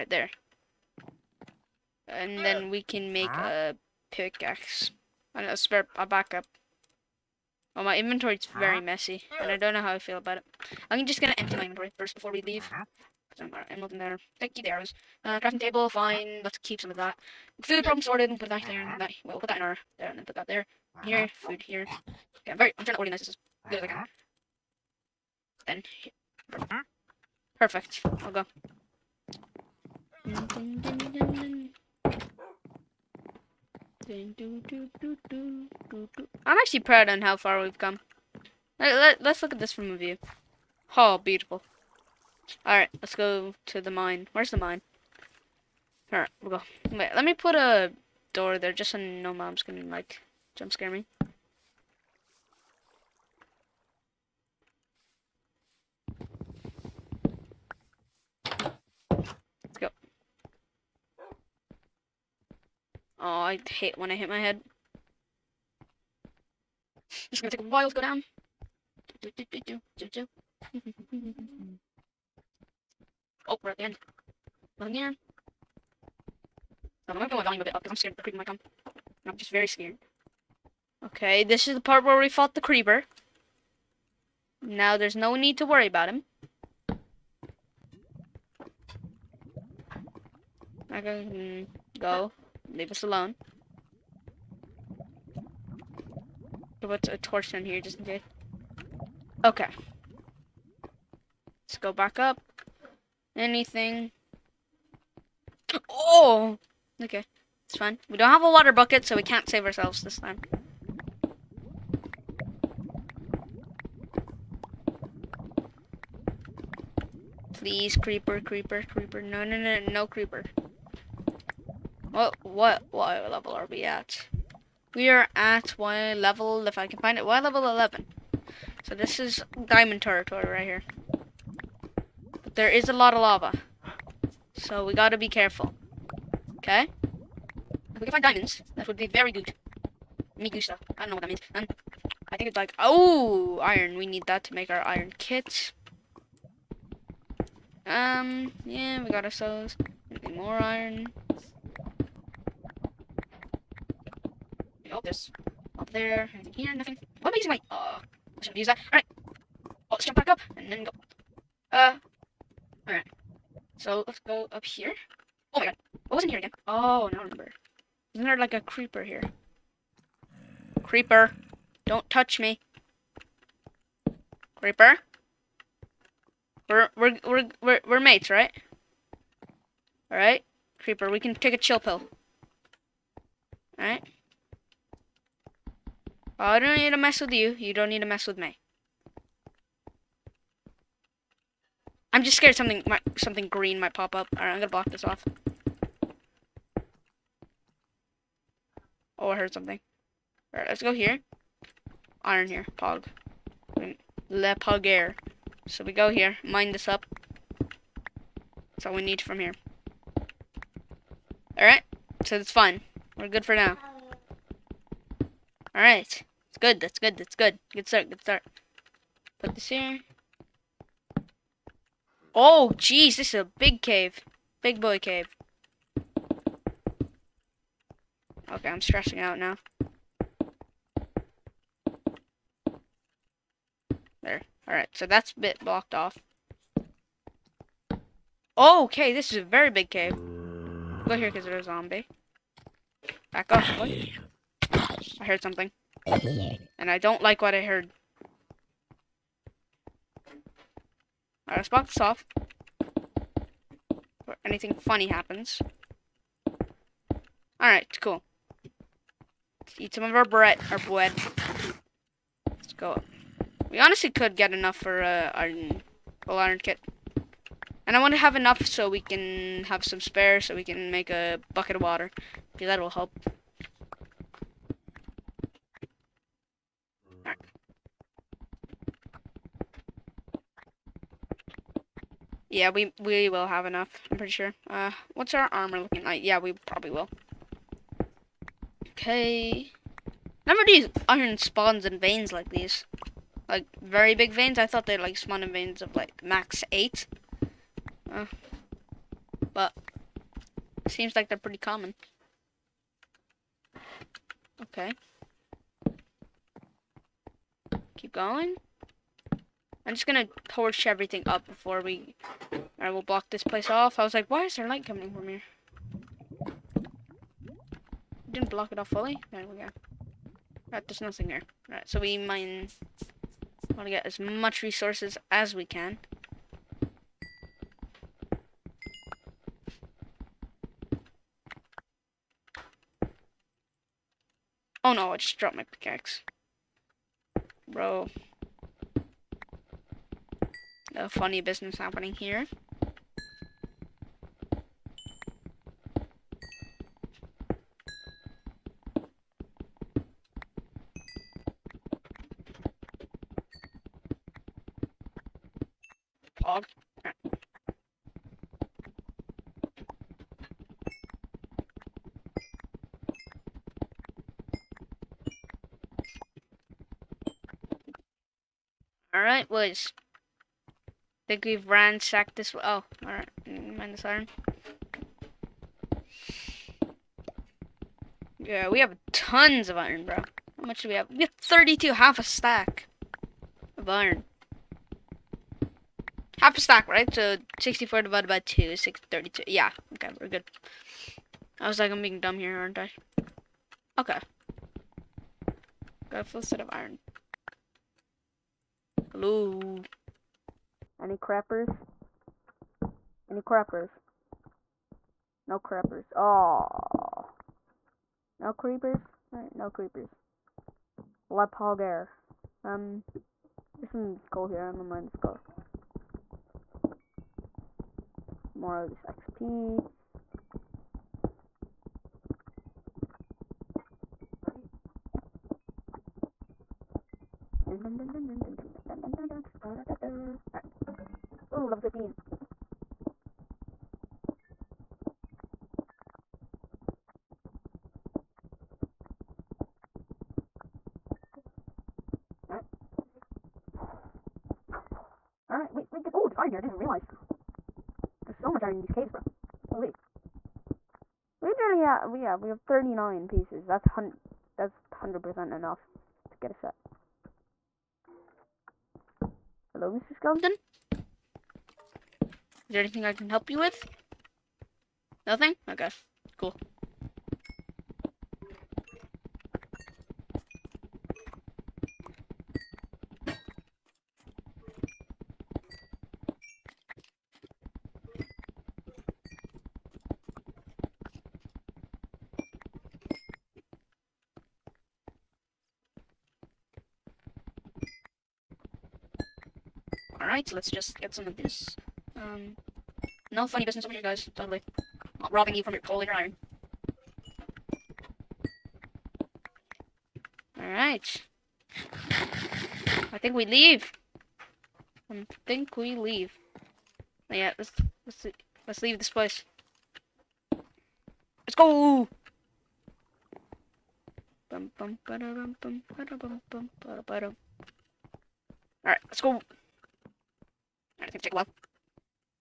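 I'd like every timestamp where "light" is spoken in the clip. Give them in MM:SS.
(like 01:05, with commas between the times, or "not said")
05:14.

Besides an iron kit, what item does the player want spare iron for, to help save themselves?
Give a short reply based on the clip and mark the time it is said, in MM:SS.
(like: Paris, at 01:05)
Bucket of water, at 04:31.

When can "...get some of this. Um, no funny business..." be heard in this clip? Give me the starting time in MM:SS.
08:10.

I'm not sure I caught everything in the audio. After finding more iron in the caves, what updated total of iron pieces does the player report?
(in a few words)
39.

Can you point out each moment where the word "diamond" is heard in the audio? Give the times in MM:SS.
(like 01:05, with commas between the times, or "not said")
02:09, 02:18.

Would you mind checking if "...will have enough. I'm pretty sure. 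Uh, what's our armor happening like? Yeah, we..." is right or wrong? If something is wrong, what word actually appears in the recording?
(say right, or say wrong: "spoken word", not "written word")
wrong: "looking", not "happening".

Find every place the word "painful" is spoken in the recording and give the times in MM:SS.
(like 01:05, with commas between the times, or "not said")
not said.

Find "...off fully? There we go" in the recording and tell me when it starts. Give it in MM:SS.
05:18.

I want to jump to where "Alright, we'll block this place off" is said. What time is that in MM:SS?
05:12.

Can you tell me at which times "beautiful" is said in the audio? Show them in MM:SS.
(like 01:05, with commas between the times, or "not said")
00:41.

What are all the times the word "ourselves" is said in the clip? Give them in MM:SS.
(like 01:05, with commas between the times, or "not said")
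01:49, 02:29.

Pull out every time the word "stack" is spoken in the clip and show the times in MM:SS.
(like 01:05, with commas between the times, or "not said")
06:22, 06:26.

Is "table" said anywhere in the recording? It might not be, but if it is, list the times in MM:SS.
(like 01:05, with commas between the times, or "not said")
00:15.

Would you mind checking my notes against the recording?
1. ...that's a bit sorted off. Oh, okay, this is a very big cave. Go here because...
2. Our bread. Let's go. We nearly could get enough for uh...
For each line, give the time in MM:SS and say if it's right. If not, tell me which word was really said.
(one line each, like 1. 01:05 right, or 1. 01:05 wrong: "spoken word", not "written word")
1. 03:55 wrong: "blocked", not "sorted"
2. 04:20 wrong: "honestly", not "nearly".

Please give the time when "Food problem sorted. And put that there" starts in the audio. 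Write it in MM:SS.
00:17.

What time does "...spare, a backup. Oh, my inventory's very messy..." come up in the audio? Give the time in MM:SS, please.
00:05.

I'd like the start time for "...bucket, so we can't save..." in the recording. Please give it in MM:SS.
01:48.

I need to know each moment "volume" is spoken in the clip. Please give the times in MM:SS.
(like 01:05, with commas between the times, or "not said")
01:17.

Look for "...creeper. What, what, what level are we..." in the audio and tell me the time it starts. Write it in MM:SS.
02:00.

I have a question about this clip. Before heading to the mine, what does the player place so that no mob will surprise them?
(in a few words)
A door.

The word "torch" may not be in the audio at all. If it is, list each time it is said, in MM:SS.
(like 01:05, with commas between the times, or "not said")
01:37, 05:10.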